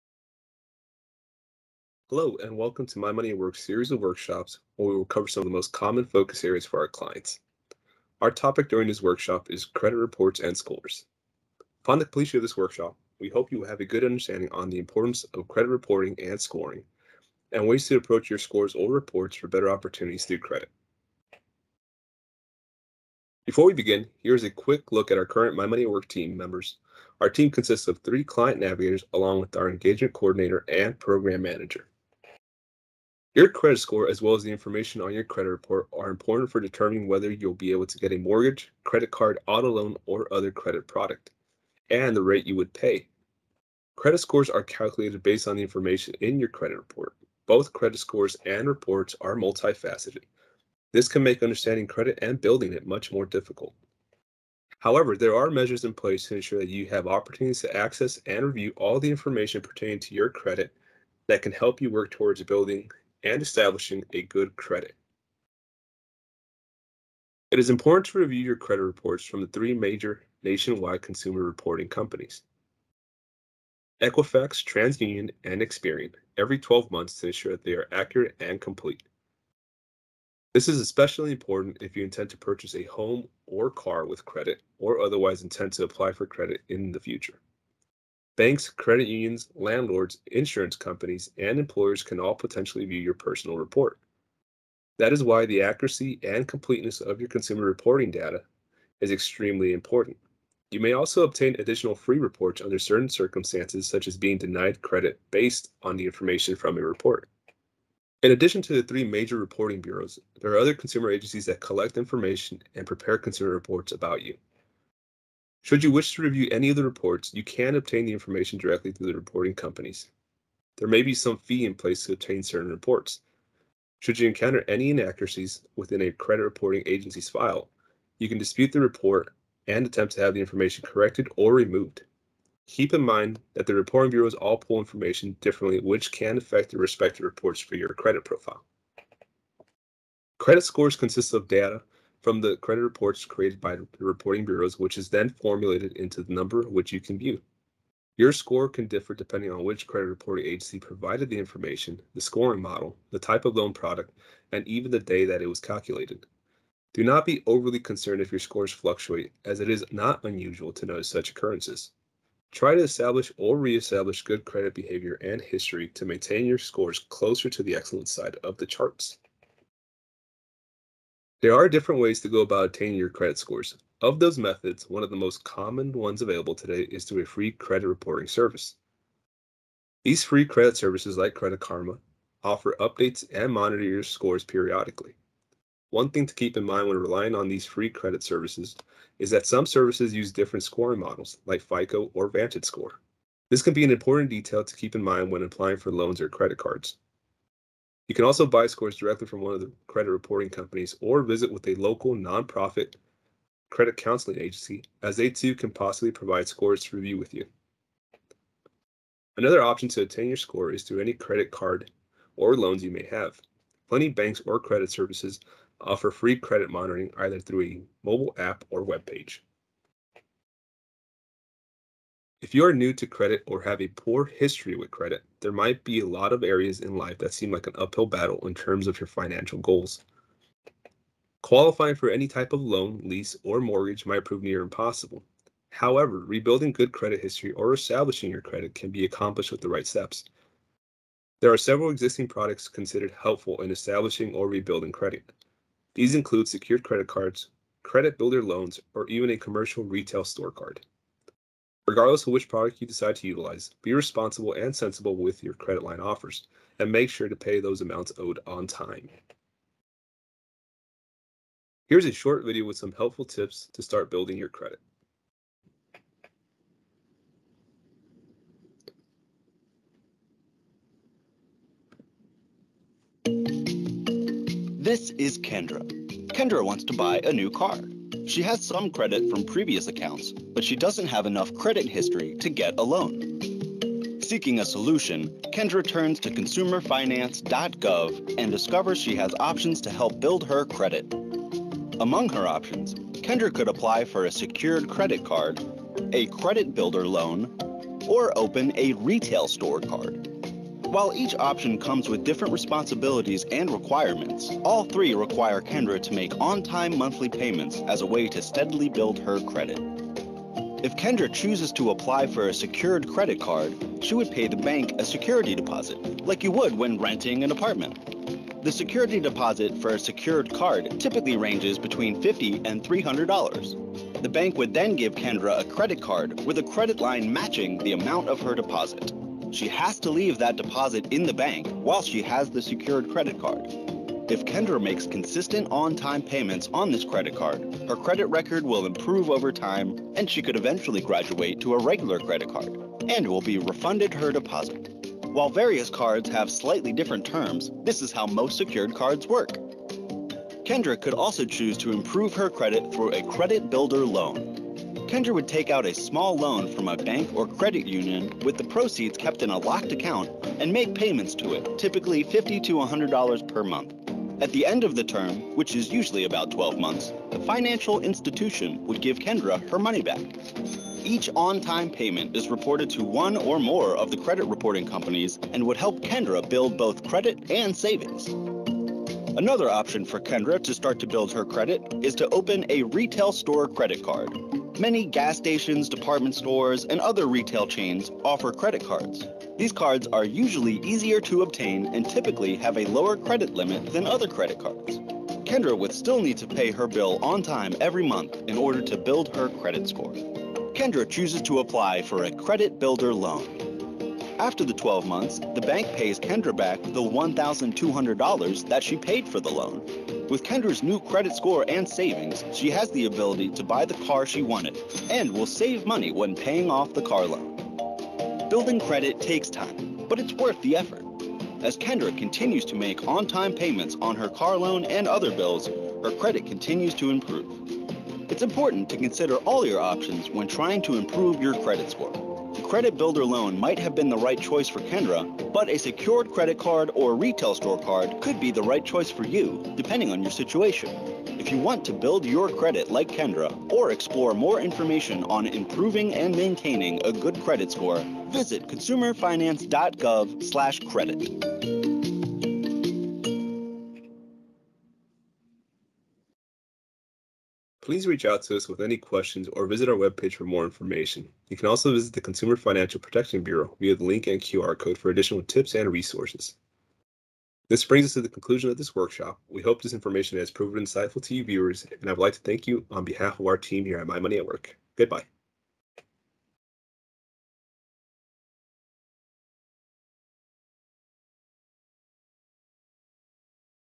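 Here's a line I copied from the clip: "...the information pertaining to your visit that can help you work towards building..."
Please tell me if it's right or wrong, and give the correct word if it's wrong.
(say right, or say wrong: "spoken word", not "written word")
wrong: "credit", not "visit".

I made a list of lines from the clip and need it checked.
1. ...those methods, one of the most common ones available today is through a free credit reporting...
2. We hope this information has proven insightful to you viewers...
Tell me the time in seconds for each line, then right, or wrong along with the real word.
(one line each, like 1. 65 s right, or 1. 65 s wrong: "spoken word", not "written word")
1. 174 s right
2. 469 s right.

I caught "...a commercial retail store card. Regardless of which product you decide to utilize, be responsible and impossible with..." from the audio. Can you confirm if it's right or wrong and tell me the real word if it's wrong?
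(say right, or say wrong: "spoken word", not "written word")
wrong: "sensible", not "impossible".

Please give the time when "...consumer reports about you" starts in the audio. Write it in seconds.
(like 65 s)
113 s.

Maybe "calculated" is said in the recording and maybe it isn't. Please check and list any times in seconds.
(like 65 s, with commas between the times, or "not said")
44 s, 155 s.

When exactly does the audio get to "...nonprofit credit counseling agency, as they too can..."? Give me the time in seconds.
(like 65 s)
202 s.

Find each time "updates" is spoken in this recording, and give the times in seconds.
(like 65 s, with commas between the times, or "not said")
182 s.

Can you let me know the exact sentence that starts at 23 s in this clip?
Before we begin, here's a quick look at our current My Money at Work team members.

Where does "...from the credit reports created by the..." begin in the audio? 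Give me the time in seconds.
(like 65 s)
142 s.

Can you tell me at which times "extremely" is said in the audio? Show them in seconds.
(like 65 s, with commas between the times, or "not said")
99 s.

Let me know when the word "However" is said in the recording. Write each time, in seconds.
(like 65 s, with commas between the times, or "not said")
54 s, 235 s.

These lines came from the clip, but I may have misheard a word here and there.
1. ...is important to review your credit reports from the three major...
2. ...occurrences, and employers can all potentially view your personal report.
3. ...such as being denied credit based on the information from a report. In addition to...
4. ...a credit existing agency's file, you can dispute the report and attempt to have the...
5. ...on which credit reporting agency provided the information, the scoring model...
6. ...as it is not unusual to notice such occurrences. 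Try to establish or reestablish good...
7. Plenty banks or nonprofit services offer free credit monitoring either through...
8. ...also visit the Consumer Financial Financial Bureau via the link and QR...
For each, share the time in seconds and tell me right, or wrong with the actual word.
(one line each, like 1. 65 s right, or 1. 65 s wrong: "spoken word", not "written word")
1. 67 s right
2. 90 s wrong: "companies", not "occurrences"
3. 103 s right
4. 126 s wrong: "reporting", not "existing"
5. 149 s right
6. 159 s right
7. 213 s wrong: "credit", not "nonprofit"
8. 461 s wrong: "Protection", not "Financial".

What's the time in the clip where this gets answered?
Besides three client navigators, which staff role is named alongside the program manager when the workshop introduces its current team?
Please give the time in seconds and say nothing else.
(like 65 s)
29 s.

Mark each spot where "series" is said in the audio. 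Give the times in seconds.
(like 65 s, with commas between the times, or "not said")
3 s.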